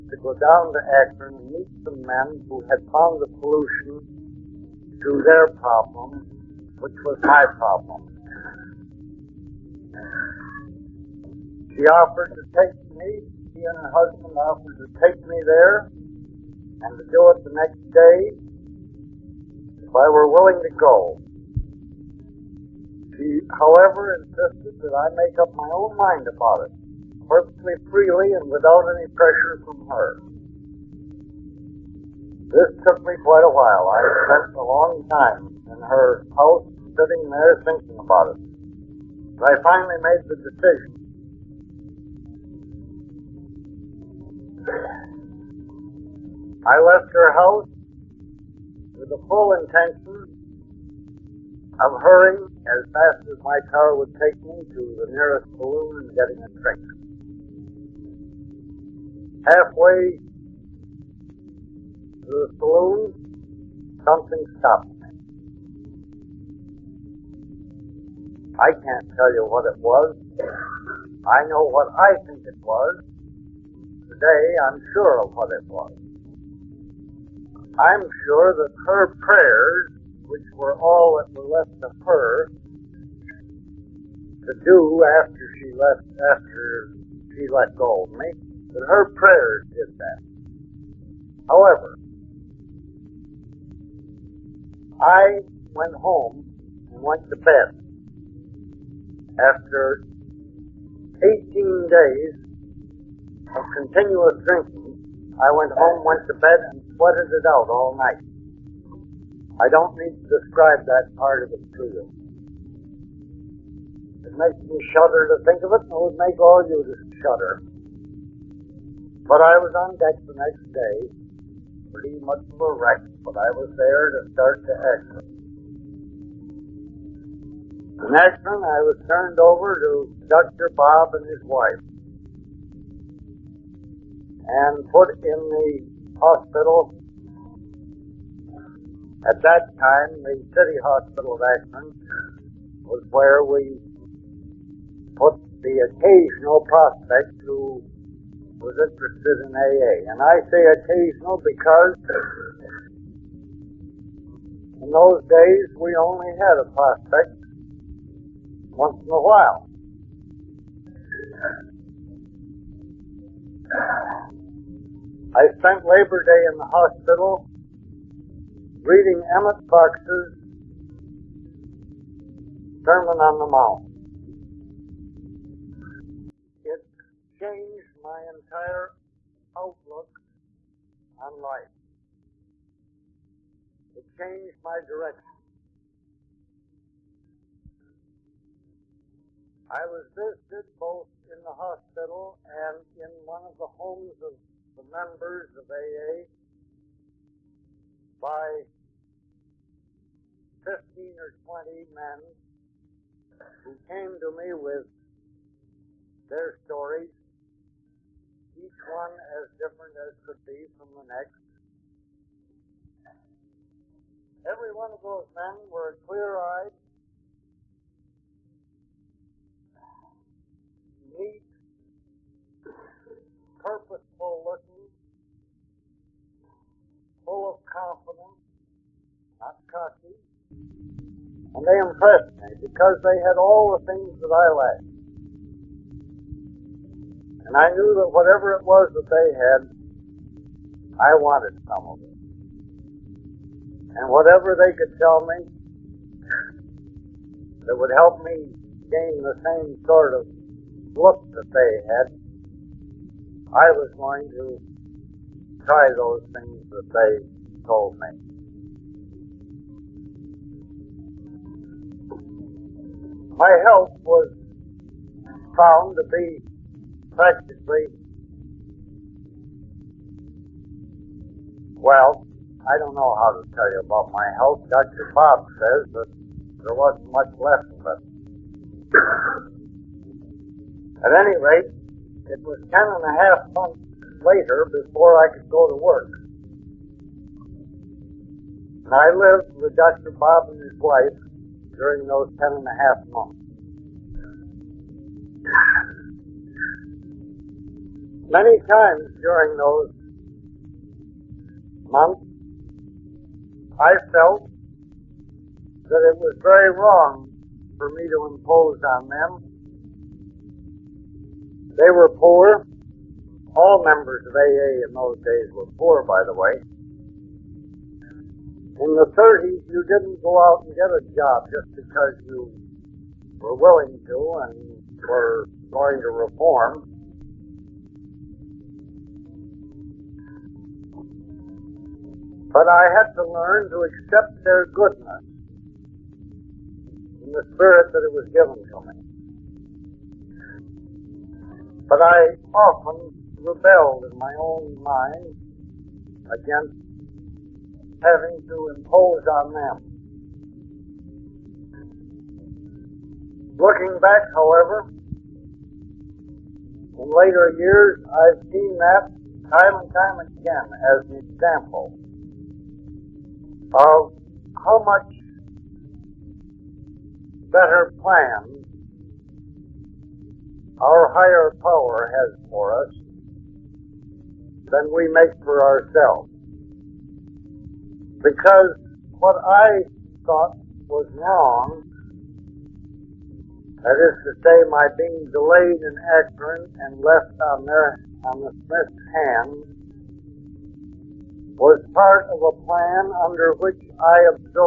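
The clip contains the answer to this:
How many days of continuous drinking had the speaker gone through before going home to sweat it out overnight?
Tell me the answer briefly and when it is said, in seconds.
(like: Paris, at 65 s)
18, at 101 s.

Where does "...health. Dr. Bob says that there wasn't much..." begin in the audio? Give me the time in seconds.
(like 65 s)
274 s.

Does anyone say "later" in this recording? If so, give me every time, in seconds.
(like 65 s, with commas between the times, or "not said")
284 s, 357 s.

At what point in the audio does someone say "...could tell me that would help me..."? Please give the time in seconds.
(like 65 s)
244 s.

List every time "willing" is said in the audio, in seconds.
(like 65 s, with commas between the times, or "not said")
20 s, 323 s.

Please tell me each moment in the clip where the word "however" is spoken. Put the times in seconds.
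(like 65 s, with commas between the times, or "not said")
23 s, 91 s, 354 s.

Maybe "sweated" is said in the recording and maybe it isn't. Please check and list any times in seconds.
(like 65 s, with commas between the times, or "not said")
106 s.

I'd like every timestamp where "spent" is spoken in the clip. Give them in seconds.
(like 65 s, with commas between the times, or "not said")
34 s, 165 s.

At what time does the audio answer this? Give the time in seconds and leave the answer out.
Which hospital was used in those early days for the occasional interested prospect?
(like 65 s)
140 s.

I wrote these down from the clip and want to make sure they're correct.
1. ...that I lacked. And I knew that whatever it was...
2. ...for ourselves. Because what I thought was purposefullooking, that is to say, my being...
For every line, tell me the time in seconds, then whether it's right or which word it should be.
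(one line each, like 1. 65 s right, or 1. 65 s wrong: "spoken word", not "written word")
1. 234 s right
2. 375 s wrong: "wrong", not "purposefullooking".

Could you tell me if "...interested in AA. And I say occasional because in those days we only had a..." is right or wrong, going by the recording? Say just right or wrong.
right.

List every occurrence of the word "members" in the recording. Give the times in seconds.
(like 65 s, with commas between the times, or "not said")
194 s, 313 s.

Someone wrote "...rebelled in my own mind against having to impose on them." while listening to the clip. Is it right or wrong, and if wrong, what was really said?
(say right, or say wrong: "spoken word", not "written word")
right.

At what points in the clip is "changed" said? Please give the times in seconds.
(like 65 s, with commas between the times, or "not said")
177 s, 184 s.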